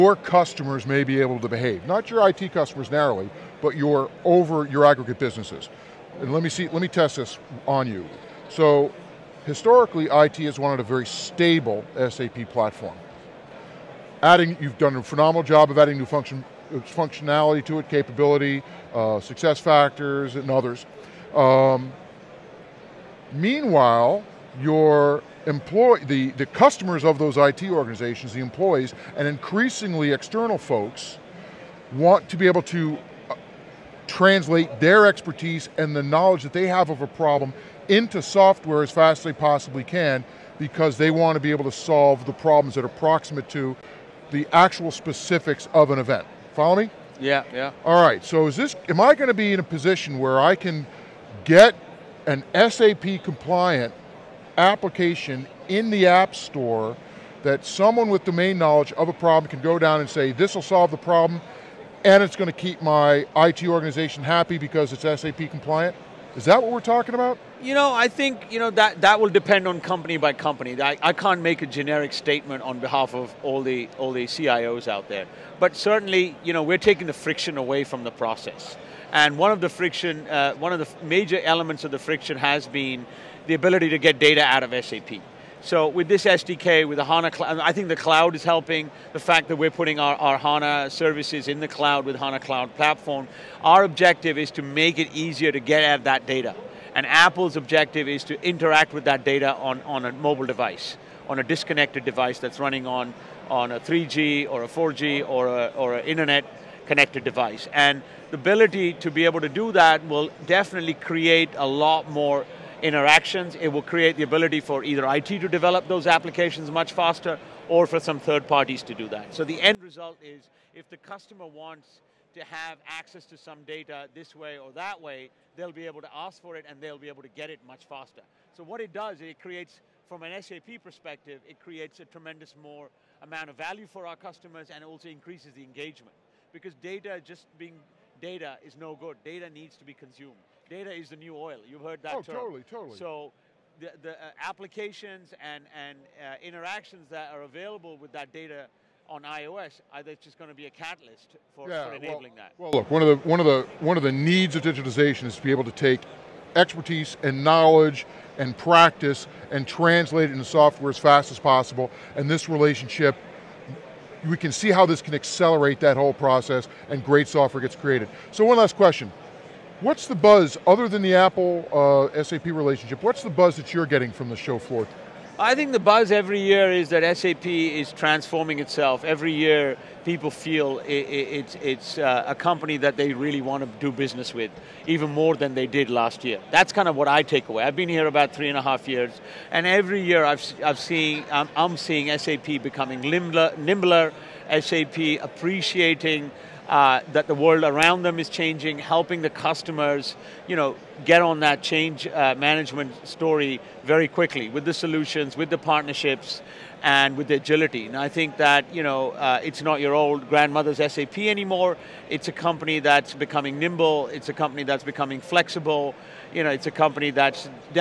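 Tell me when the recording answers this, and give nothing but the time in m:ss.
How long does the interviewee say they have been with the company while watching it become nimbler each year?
3:08.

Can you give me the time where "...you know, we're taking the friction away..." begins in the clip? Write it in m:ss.
1:16.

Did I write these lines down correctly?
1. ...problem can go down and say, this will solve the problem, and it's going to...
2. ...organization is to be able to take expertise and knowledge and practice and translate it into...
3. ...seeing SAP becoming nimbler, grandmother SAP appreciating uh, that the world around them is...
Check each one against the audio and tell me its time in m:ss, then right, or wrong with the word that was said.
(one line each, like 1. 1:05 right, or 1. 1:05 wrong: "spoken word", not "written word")
1. 0:59 right
2. 2:34 wrong: "digitization", not "organization"
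3. 3:11 wrong: "nimbler", not "grandmother".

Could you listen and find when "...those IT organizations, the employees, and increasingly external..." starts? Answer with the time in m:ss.
0:27.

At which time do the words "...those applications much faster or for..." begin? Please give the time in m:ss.
1:55.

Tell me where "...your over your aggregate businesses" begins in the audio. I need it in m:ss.
0:03.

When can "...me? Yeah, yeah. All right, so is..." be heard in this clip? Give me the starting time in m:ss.
0:46.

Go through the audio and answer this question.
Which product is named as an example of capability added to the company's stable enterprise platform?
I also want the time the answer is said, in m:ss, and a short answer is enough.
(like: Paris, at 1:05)
SuccessFactors, at 0:19.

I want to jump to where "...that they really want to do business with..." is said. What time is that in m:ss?
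3:02.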